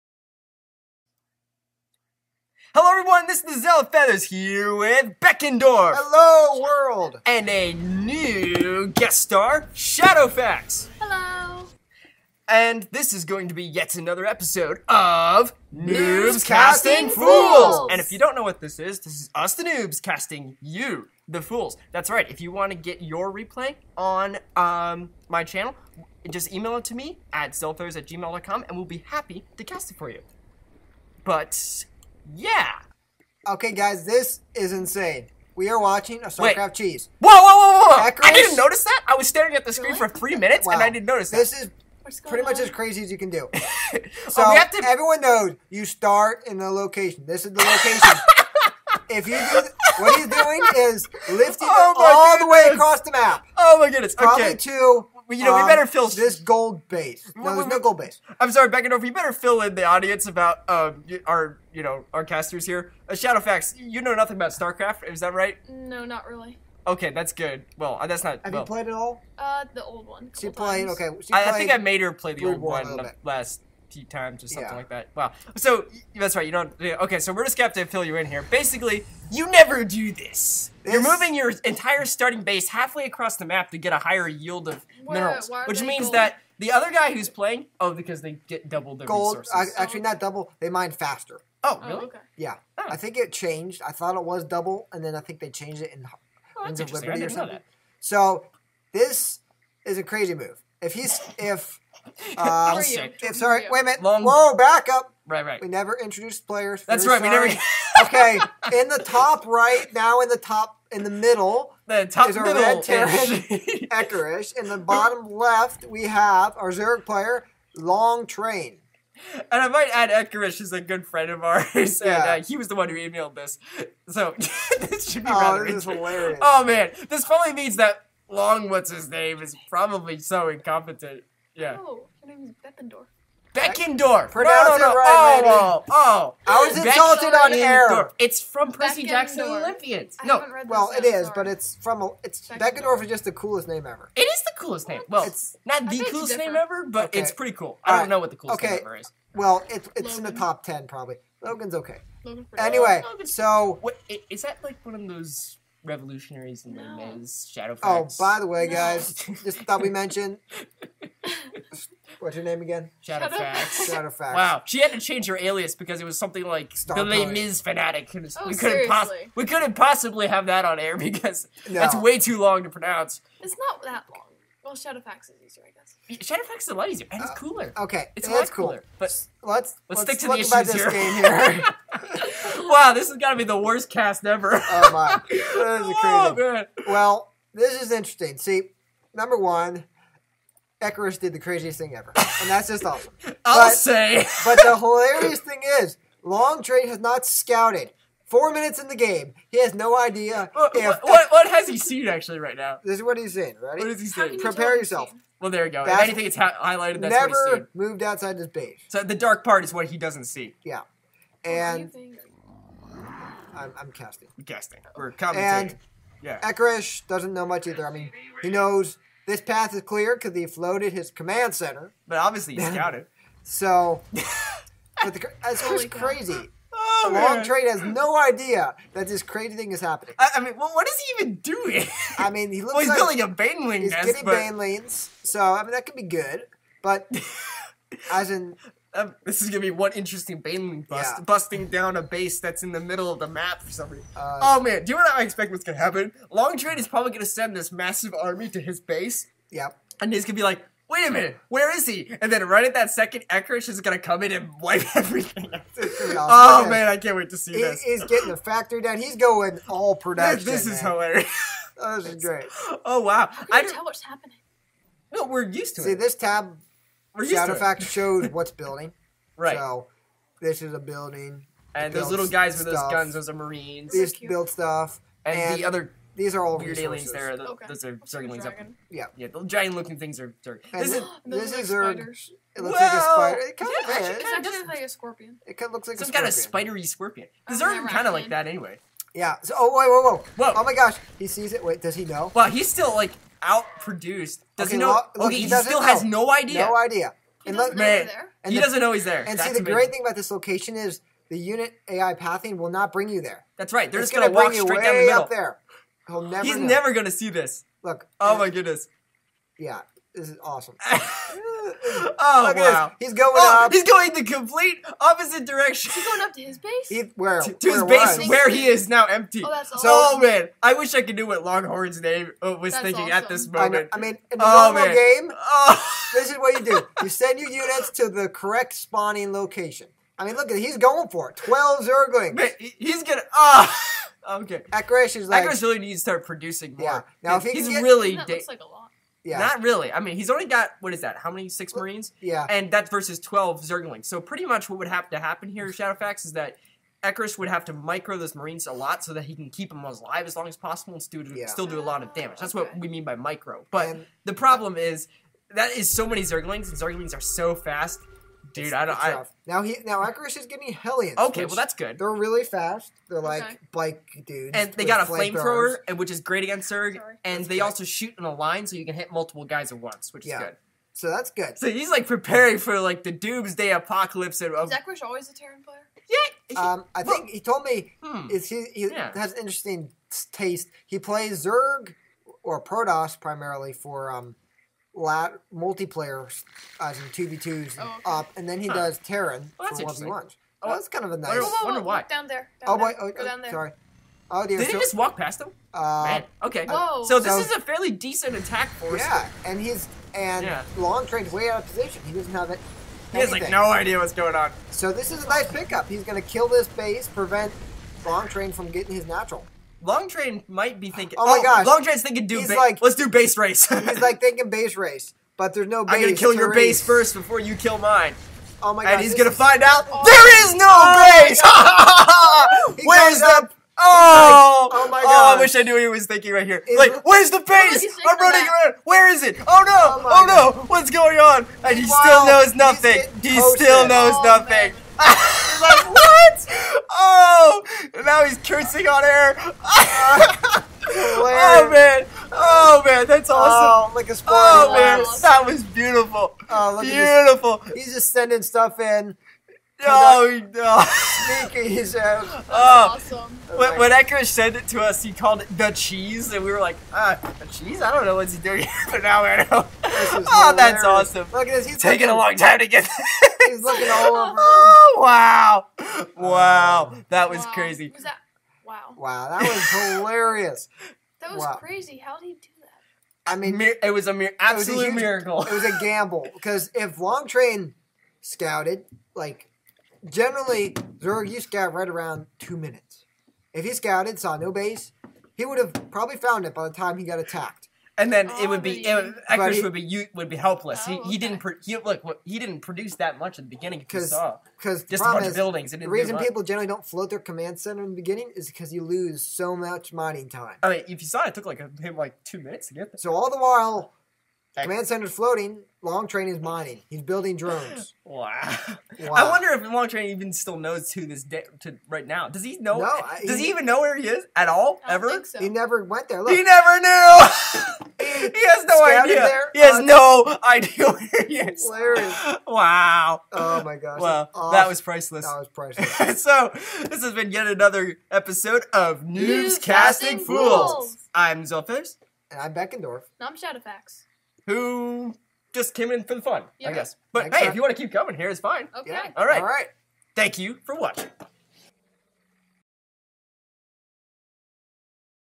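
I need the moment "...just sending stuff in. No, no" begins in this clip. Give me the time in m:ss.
7:27.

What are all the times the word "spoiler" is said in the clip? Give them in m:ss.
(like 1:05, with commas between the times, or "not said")
7:24.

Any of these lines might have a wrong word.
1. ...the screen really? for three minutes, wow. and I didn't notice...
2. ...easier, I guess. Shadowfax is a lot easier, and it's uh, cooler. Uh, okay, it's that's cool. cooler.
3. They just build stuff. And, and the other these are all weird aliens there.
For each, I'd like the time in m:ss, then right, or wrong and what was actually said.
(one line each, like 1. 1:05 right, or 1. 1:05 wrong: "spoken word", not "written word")
1. 0:39 right
2. 2:55 right
3. 4:33 right.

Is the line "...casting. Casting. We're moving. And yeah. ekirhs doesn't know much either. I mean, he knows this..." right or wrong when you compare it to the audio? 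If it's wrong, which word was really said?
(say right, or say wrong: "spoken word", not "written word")
wrong: "commentating", not "moving".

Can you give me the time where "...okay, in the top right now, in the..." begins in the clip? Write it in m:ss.
1:48.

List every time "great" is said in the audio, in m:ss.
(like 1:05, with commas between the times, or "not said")
4:22, 4:59, 6:06.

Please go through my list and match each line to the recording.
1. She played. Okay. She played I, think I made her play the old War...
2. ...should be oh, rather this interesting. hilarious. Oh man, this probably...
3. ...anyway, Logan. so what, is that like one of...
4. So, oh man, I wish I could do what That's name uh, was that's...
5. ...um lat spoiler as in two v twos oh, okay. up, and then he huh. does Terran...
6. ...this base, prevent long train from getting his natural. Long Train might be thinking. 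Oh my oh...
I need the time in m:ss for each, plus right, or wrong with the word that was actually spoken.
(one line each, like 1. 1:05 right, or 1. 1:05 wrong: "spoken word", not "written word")
1. 1:10 right
2. 2:05 right
3. 2:32 right
4. 5:19 wrong: "Longhorn", not "That"
5. 6:24 wrong: "multiplayer", not "spoiler"
6. 6:46 right.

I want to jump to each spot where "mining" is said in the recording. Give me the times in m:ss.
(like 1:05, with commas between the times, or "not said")
8:19, 8:26.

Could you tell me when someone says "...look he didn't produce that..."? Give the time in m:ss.
8:11.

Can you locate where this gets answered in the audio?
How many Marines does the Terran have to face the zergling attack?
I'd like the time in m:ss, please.
5:41.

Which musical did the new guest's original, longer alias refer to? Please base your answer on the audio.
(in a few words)
Les Mis.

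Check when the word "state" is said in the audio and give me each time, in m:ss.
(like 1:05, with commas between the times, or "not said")
not said.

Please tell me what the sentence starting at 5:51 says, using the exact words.
still do a lot of damage.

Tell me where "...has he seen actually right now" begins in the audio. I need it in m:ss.
3:21.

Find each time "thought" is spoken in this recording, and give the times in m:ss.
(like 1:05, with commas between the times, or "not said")
1:33, 2:39.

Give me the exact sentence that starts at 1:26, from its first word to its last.
that the other guy who's playing, oh, because they get double their gold, resources.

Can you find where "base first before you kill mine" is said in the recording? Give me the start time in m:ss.
6:56.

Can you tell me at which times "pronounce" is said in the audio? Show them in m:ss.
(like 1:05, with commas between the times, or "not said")
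2:14, 2:52.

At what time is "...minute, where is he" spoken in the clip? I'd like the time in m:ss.
4:11.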